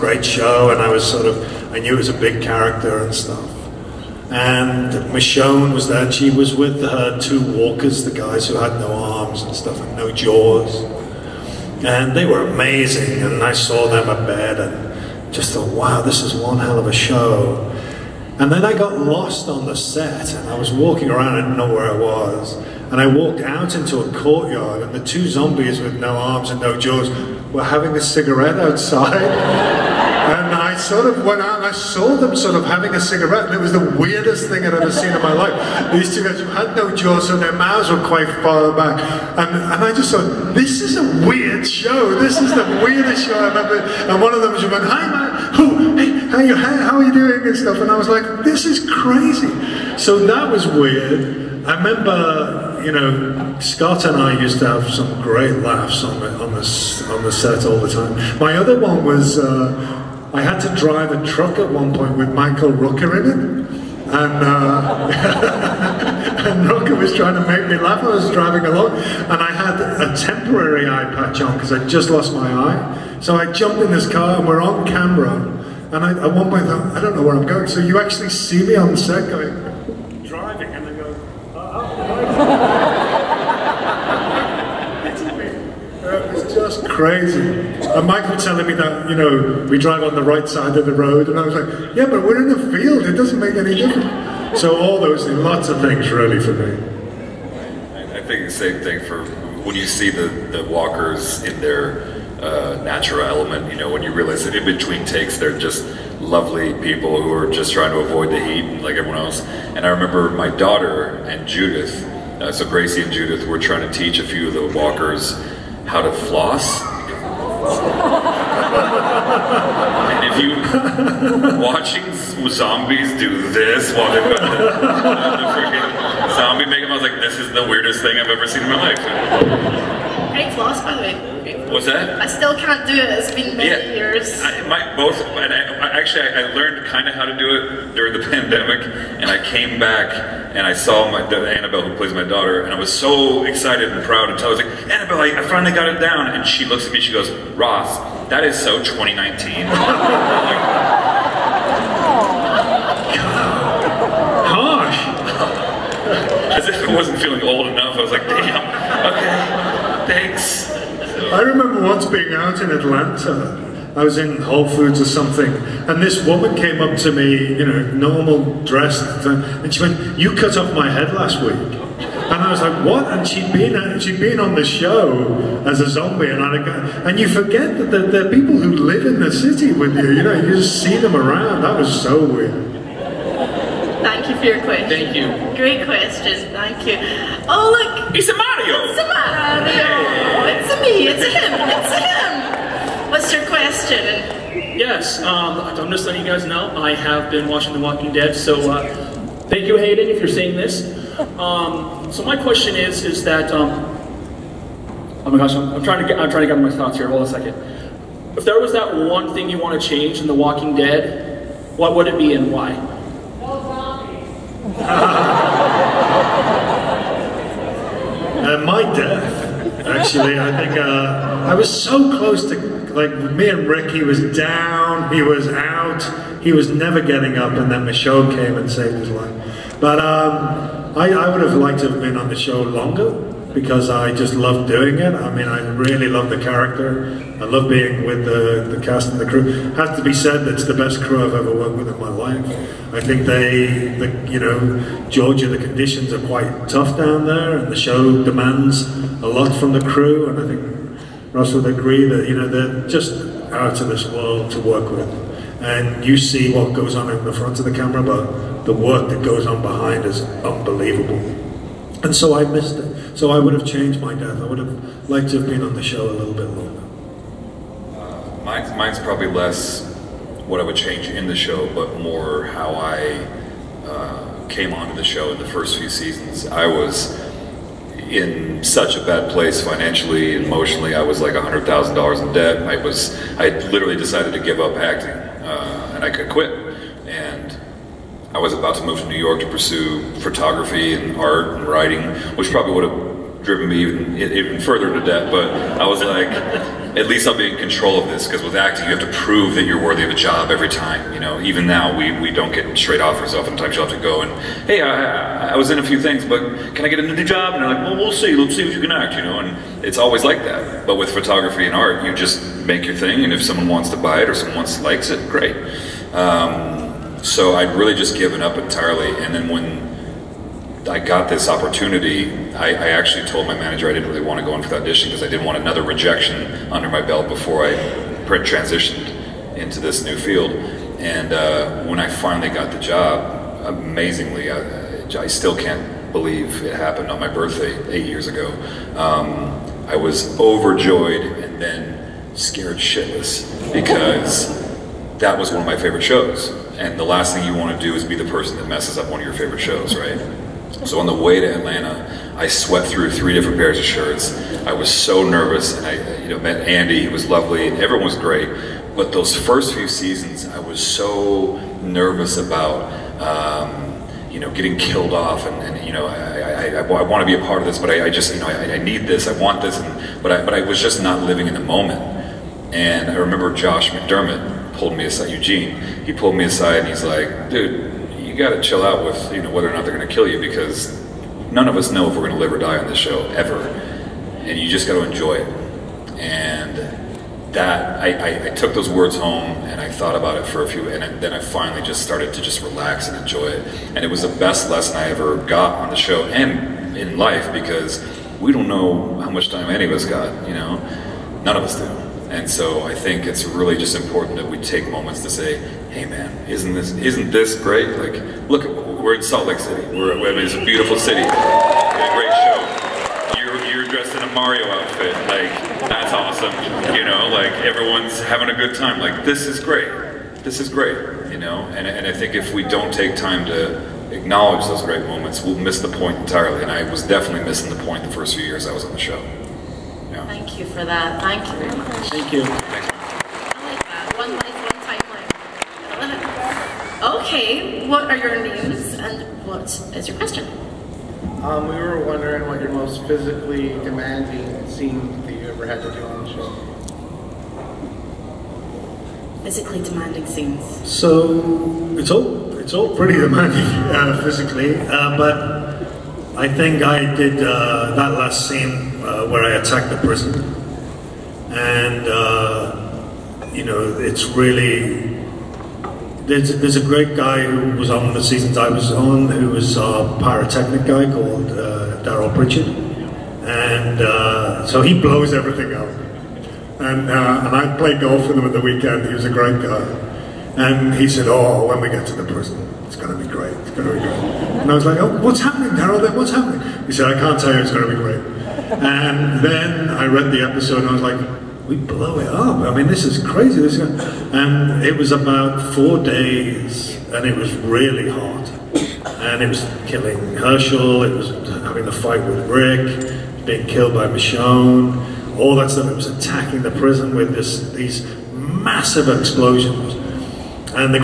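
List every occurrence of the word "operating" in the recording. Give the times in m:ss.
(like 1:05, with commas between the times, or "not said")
not said.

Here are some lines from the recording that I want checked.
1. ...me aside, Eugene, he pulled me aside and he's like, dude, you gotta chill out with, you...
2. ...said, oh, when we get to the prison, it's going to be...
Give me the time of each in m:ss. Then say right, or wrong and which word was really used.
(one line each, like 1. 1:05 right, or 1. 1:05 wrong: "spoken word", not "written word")
1. 6:14 right
2. 8:01 right.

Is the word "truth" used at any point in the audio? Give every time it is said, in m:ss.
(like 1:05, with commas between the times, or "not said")
not said.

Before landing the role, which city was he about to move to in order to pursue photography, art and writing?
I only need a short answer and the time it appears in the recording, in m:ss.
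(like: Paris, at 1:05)
New York, at 4:49.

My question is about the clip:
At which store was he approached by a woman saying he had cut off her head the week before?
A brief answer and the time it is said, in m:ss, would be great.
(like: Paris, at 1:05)
Whole Foods, at 2:44.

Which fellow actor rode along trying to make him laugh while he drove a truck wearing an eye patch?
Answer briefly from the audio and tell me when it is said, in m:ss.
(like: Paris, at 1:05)
Michael Rooker, at 1:02.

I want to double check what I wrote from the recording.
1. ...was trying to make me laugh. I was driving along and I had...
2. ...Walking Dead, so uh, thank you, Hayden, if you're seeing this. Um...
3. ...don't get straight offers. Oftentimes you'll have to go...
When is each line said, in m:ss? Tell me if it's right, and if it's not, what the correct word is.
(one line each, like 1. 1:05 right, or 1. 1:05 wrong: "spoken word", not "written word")
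1. 1:06 right
2. 3:17 right
3. 5:02 right.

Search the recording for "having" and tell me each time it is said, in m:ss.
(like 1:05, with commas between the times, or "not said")
0:27, 0:32, 6:58, 8:21.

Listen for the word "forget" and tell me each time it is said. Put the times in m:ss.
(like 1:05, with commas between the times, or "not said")
2:57.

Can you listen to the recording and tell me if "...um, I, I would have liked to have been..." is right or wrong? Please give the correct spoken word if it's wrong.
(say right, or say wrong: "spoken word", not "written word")
right.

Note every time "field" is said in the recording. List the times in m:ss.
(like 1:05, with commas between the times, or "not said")
1:32, 5:30.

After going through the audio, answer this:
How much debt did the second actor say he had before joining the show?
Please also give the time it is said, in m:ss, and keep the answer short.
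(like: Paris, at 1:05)
$100,000, at 4:41.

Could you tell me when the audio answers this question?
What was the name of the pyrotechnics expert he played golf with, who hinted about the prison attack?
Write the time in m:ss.
7:52.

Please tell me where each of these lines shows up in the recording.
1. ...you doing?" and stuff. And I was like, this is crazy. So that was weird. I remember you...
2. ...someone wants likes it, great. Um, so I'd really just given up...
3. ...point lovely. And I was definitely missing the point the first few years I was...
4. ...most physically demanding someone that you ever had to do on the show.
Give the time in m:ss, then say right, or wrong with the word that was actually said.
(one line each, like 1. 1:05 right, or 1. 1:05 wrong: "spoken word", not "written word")
1. 0:47 right
2. 5:14 right
3. 7:05 wrong: "entirely", not "lovely"
4. 7:22 wrong: "scene", not "someone".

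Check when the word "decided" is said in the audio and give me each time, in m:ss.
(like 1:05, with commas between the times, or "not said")
4:43.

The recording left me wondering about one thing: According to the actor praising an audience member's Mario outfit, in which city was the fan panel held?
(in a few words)
Salt Lake City.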